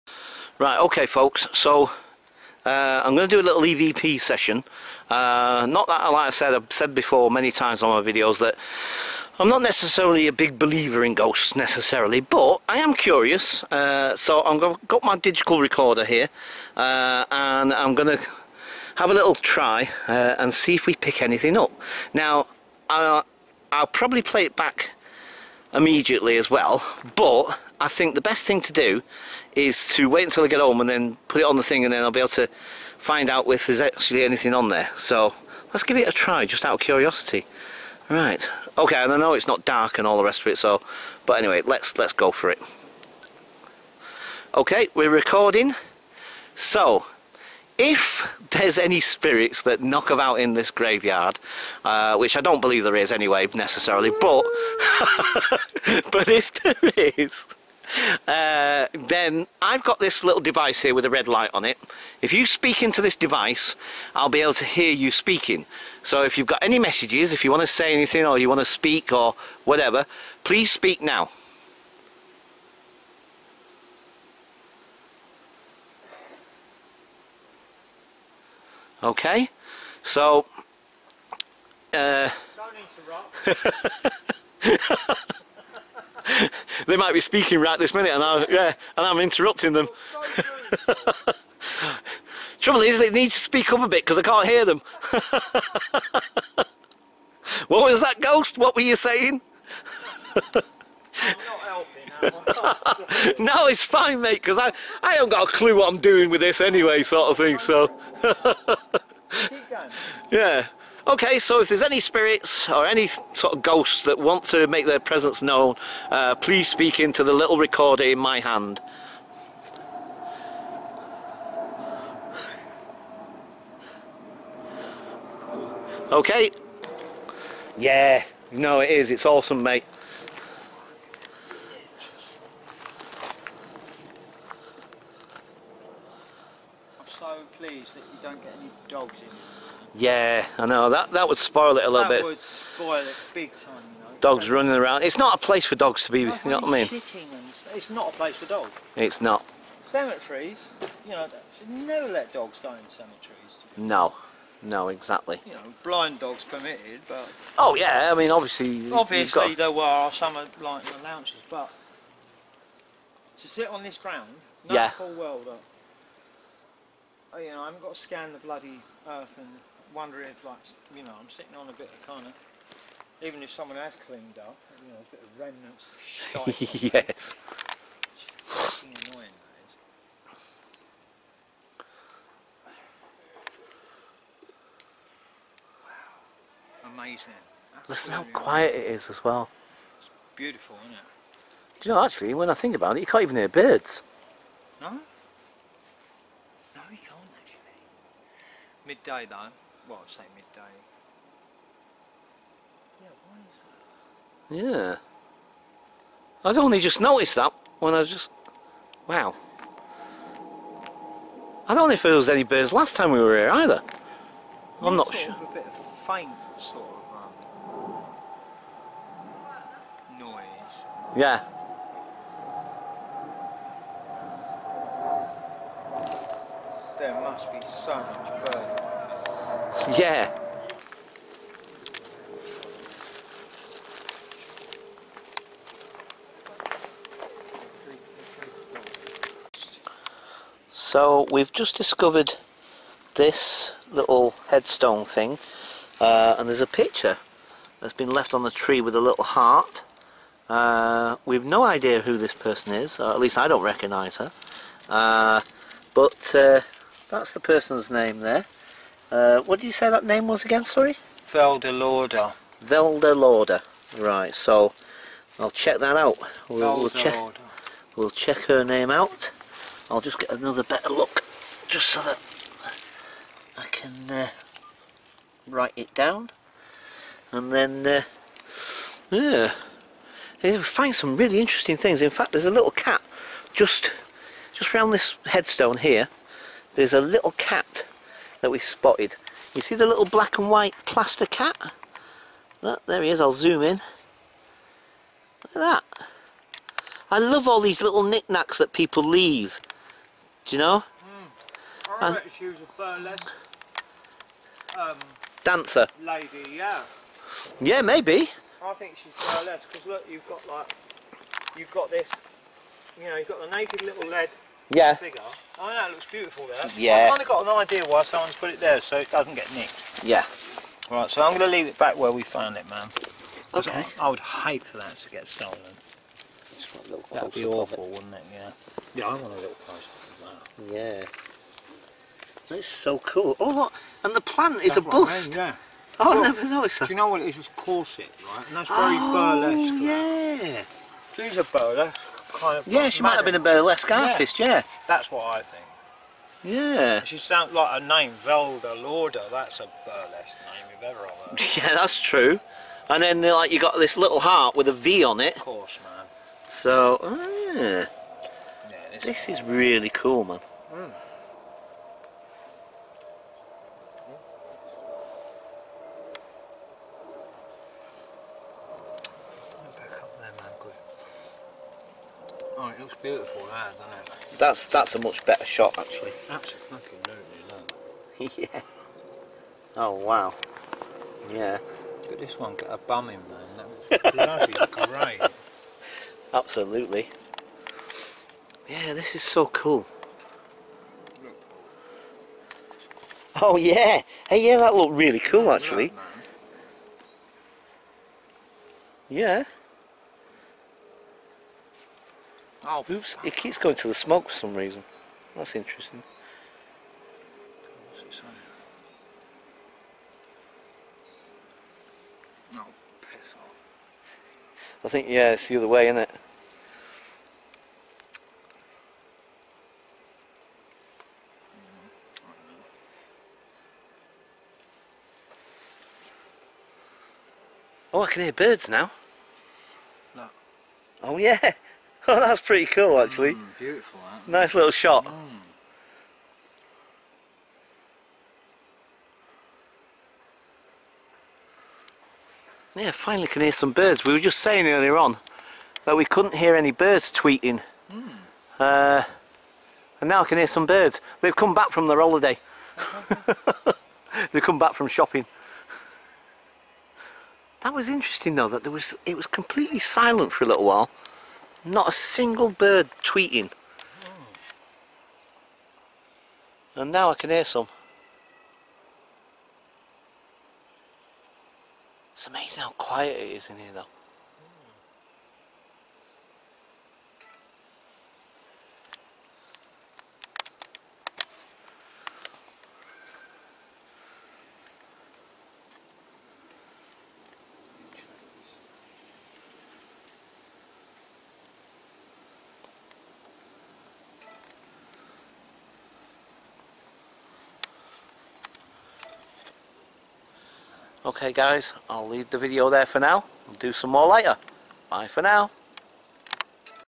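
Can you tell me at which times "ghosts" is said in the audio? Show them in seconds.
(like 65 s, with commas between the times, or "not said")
11 s, 98 s, 113 s.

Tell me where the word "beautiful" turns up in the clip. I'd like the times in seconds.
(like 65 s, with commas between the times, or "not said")
190 s, 316 s, 372 s, 433 s.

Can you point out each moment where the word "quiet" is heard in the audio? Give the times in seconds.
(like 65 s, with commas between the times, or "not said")
188 s, 472 s.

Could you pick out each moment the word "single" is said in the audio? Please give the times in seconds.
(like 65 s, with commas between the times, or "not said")
461 s.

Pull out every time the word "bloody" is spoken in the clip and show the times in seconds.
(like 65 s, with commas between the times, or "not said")
168 s, 384 s.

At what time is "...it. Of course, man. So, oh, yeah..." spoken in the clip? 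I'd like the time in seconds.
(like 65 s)
355 s.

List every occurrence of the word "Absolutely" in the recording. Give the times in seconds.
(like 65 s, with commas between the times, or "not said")
376 s, 386 s.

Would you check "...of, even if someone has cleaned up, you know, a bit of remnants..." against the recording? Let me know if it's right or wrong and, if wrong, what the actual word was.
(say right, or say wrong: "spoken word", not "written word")
right.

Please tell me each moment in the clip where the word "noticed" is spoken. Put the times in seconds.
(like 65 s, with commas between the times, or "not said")
207 s, 336 s.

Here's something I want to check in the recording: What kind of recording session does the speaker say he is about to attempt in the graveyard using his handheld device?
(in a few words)
EVP session.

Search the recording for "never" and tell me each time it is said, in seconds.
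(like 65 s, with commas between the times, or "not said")
151 s, 336 s.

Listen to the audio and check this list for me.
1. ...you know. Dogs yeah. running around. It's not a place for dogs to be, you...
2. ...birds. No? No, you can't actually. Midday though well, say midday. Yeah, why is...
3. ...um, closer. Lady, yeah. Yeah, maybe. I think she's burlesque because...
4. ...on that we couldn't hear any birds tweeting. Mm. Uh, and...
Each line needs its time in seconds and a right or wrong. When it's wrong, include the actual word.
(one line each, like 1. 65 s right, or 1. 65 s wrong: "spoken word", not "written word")
1. 143 s right
2. 193 s right
3. 304 s wrong: "dancer", not "closer"
4. 444 s right.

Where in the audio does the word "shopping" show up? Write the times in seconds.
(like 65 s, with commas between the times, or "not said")
454 s.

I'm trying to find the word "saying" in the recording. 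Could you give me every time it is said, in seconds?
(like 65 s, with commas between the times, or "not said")
98 s, 444 s.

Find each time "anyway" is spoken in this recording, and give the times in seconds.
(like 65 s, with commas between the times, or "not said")
41 s, 53 s, 106 s.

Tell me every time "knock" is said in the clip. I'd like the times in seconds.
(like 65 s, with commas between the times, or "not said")
49 s.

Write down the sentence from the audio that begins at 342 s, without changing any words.
Yeah, she might have been a burlesque artist.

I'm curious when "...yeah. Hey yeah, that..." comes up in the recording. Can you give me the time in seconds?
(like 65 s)
393 s.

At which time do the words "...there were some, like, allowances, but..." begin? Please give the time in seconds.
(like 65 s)
159 s.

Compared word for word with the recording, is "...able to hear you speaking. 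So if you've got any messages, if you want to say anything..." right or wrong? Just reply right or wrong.
right.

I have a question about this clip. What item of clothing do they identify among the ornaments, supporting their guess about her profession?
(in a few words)
Corset.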